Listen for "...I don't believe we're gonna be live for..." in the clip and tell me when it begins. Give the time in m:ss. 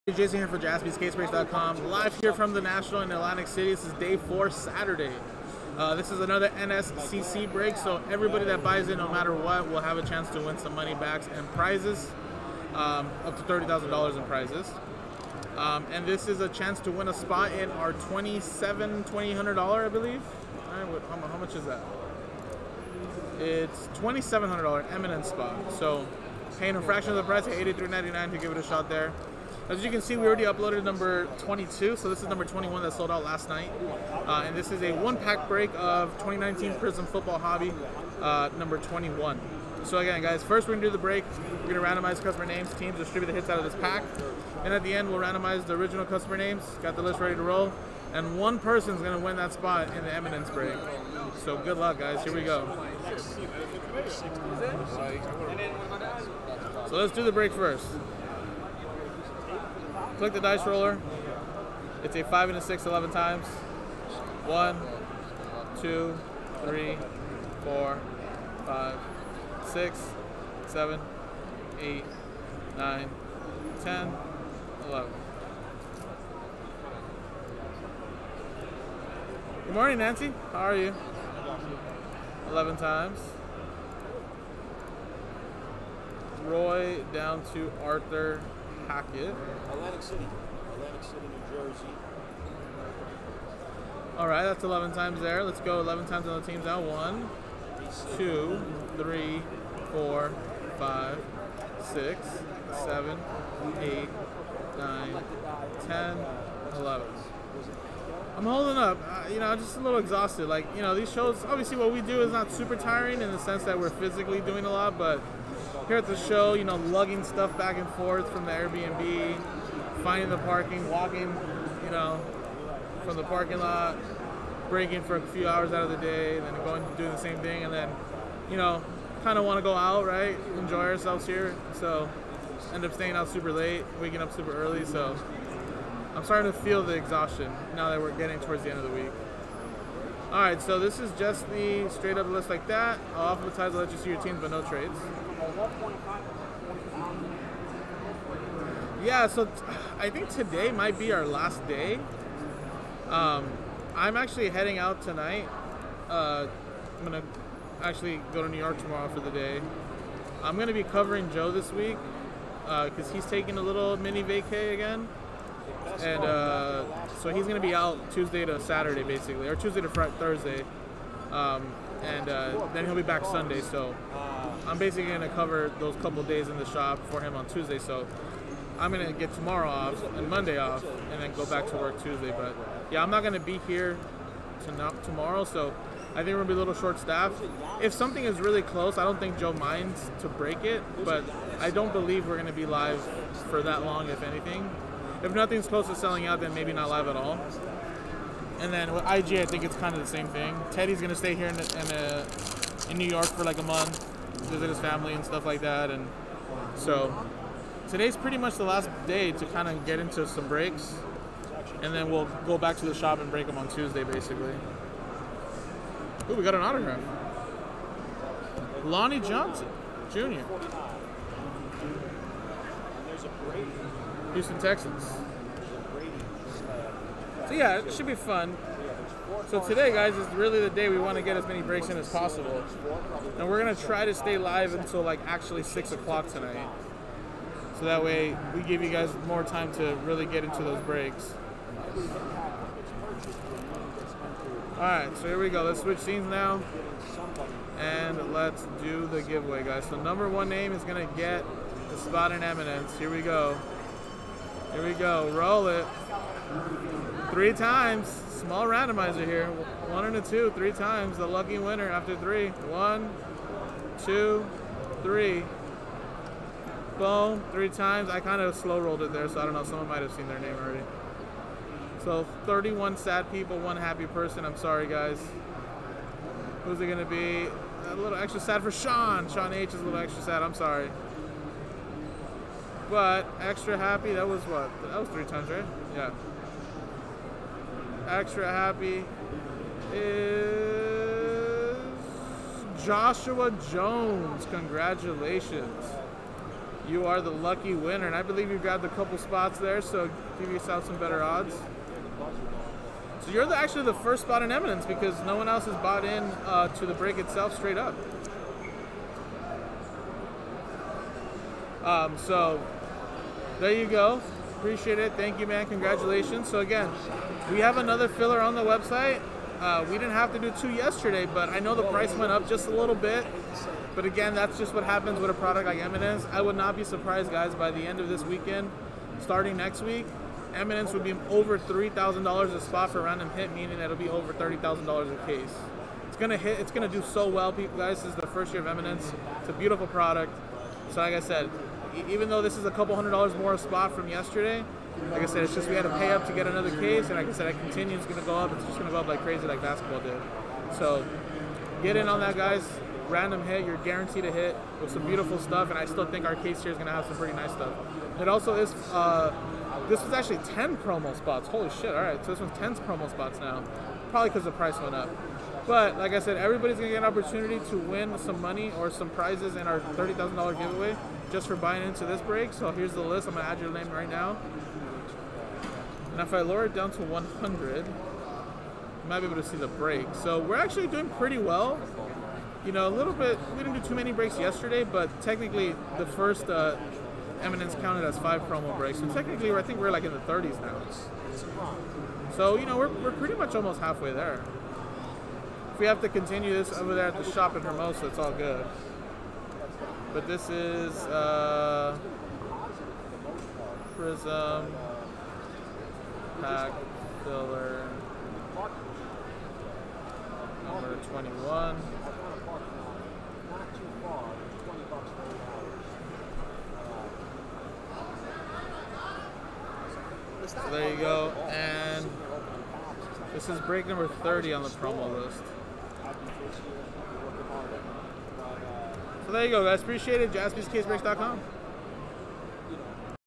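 3:11.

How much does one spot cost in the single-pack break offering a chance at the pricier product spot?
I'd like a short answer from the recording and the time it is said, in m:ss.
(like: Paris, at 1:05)
$83.99, at 0:27.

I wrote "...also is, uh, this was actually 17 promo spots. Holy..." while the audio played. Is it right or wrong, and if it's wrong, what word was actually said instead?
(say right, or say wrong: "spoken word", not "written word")
wrong: "10", not "17".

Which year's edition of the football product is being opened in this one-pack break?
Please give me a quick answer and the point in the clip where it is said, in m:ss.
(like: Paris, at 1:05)
2019, at 0:36.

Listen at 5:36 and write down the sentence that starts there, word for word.
It's gonna do so well, people.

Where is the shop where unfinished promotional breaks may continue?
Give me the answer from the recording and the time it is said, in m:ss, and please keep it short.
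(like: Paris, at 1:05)
Hermosa, at 6:37.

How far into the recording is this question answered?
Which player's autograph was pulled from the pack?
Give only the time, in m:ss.
3:38.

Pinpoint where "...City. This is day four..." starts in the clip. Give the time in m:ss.
0:03.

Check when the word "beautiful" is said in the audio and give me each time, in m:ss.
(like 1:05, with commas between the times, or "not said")
5:39, 5:55.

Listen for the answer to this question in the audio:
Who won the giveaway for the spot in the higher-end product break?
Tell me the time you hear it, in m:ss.
4:52.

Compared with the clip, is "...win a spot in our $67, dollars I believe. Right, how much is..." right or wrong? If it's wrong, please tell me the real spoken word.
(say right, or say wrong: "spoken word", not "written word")
wrong: "27", not "67".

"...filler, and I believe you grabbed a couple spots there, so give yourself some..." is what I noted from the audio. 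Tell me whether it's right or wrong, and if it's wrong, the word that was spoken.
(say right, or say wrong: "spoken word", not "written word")
wrong: "winner", not "filler".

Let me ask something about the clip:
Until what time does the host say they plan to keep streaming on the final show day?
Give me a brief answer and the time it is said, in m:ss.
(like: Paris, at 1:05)
6 o'clock, at 3:55.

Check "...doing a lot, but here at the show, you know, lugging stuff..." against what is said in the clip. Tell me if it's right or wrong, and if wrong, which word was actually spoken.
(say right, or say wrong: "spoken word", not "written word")
right.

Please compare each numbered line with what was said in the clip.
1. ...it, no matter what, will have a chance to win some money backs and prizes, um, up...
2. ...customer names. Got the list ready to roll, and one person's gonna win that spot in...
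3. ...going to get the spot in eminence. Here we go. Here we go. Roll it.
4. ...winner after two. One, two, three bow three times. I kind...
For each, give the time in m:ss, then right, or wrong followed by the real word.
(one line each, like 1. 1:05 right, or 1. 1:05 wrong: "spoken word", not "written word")
1. 0:08 right
2. 0:46 right
3. 4:10 right
4. 4:21 wrong: "three", not "two".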